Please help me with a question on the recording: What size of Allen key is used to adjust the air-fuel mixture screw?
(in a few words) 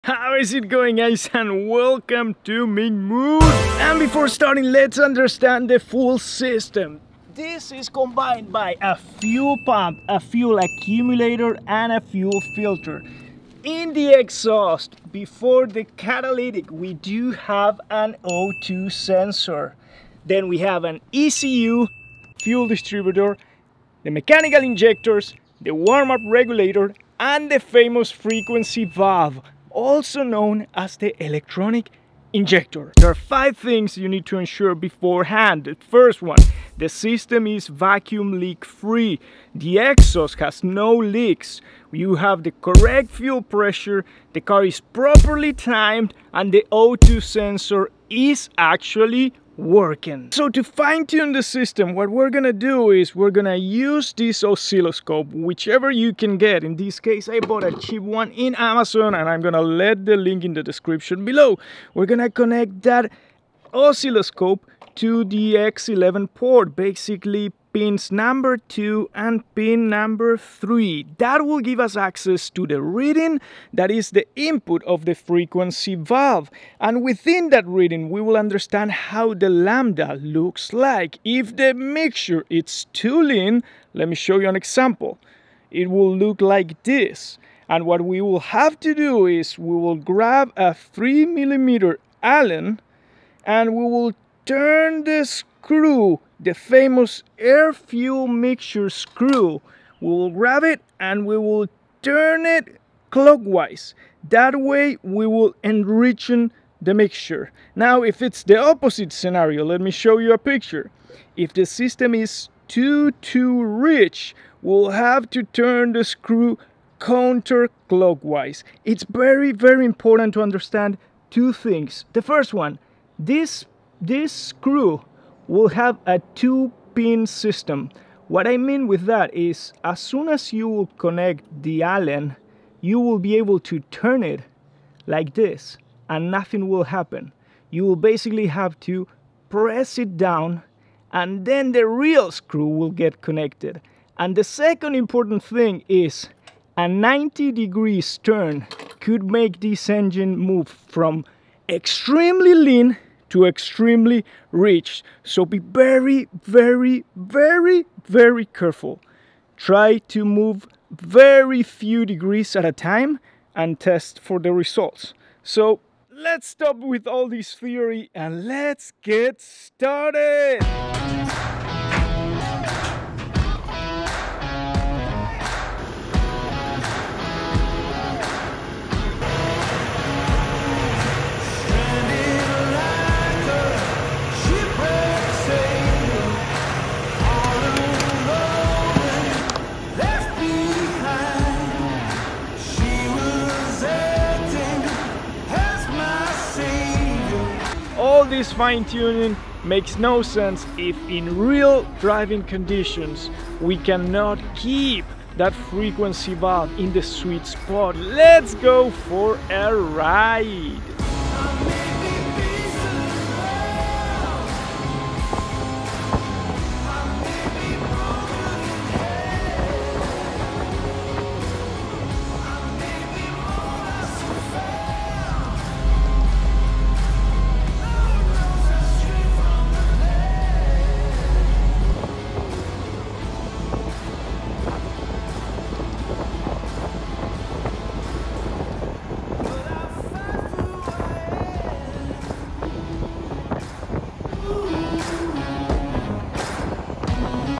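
3 millimeter.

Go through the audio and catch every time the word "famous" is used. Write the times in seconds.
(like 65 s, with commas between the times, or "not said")
27 s, 96 s.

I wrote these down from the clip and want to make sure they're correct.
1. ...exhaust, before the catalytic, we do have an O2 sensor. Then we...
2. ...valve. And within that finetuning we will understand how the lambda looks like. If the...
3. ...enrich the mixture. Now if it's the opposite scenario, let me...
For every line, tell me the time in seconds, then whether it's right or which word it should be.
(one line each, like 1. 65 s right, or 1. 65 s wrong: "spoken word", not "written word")
1. 14 s right
2. 75 s wrong: "reading", not "finetuning"
3. 105 s right.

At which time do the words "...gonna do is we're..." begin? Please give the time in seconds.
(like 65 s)
52 s.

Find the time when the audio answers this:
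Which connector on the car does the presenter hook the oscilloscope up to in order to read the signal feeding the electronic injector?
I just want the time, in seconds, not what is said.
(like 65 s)
65 s.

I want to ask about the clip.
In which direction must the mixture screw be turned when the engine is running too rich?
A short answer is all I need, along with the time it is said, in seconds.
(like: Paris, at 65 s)
counterclockwise, at 116 s.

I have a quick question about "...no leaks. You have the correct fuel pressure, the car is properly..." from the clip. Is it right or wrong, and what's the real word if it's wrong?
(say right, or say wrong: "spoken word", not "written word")
right.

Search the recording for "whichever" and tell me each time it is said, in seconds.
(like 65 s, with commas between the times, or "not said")
55 s.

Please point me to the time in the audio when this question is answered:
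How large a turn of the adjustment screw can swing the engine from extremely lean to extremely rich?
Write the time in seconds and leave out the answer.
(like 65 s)
146 s.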